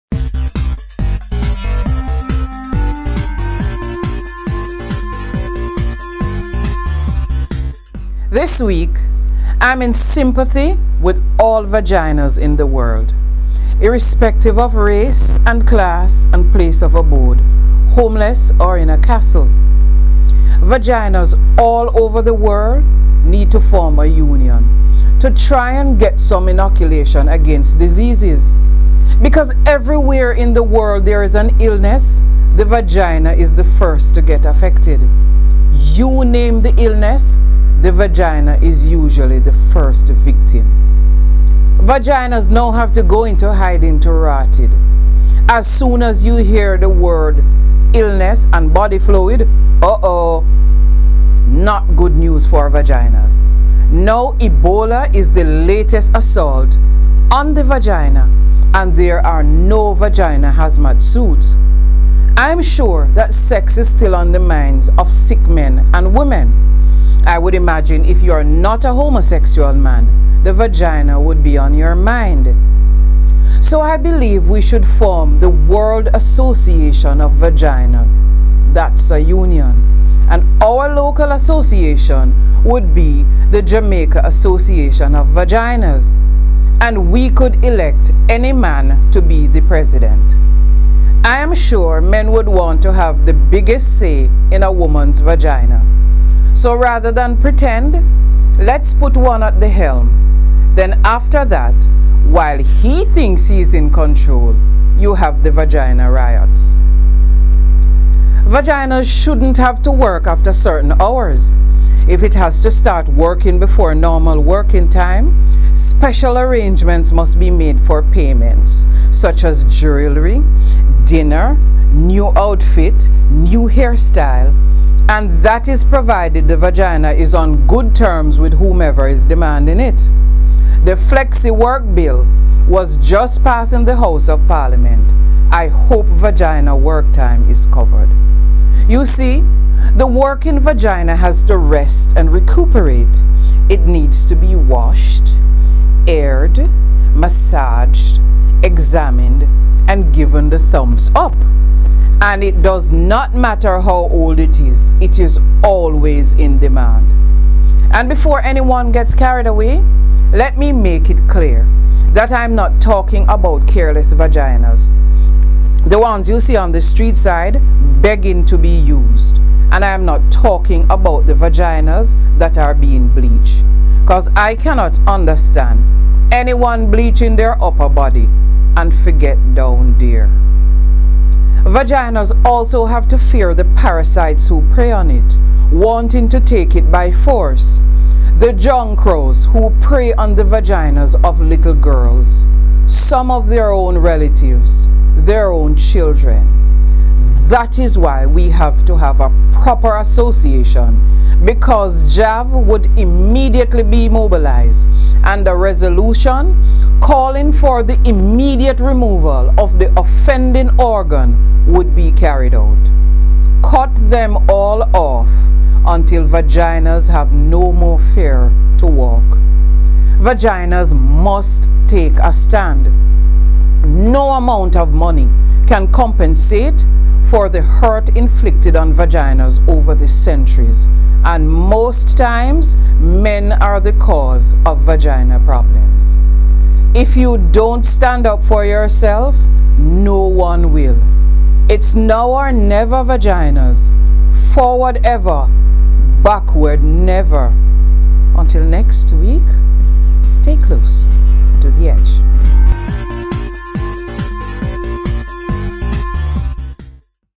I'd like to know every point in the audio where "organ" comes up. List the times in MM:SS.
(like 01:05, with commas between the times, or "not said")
03:30.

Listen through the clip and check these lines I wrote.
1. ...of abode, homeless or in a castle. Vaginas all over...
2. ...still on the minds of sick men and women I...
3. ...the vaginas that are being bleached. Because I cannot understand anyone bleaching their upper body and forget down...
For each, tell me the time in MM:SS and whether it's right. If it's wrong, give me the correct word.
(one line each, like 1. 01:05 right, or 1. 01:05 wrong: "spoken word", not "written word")
1. 00:16 right
2. 01:03 right
3. 02:51 right.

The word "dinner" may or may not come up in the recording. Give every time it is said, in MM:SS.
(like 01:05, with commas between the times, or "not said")
02:01.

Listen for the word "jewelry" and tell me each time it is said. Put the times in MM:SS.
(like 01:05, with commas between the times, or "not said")
01:59.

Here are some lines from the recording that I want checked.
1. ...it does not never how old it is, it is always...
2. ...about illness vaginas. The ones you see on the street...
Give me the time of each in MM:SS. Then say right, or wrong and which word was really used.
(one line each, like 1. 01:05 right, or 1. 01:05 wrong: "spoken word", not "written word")
1. 02:32 wrong: "matter", not "never"
2. 02:43 wrong: "careless", not "illness".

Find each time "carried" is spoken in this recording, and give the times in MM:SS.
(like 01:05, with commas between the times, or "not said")
02:39, 03:32.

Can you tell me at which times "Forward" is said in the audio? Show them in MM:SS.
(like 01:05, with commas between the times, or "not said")
04:04.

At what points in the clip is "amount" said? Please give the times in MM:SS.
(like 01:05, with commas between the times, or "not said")
03:44.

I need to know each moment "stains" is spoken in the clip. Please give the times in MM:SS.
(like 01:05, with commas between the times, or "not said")
not said.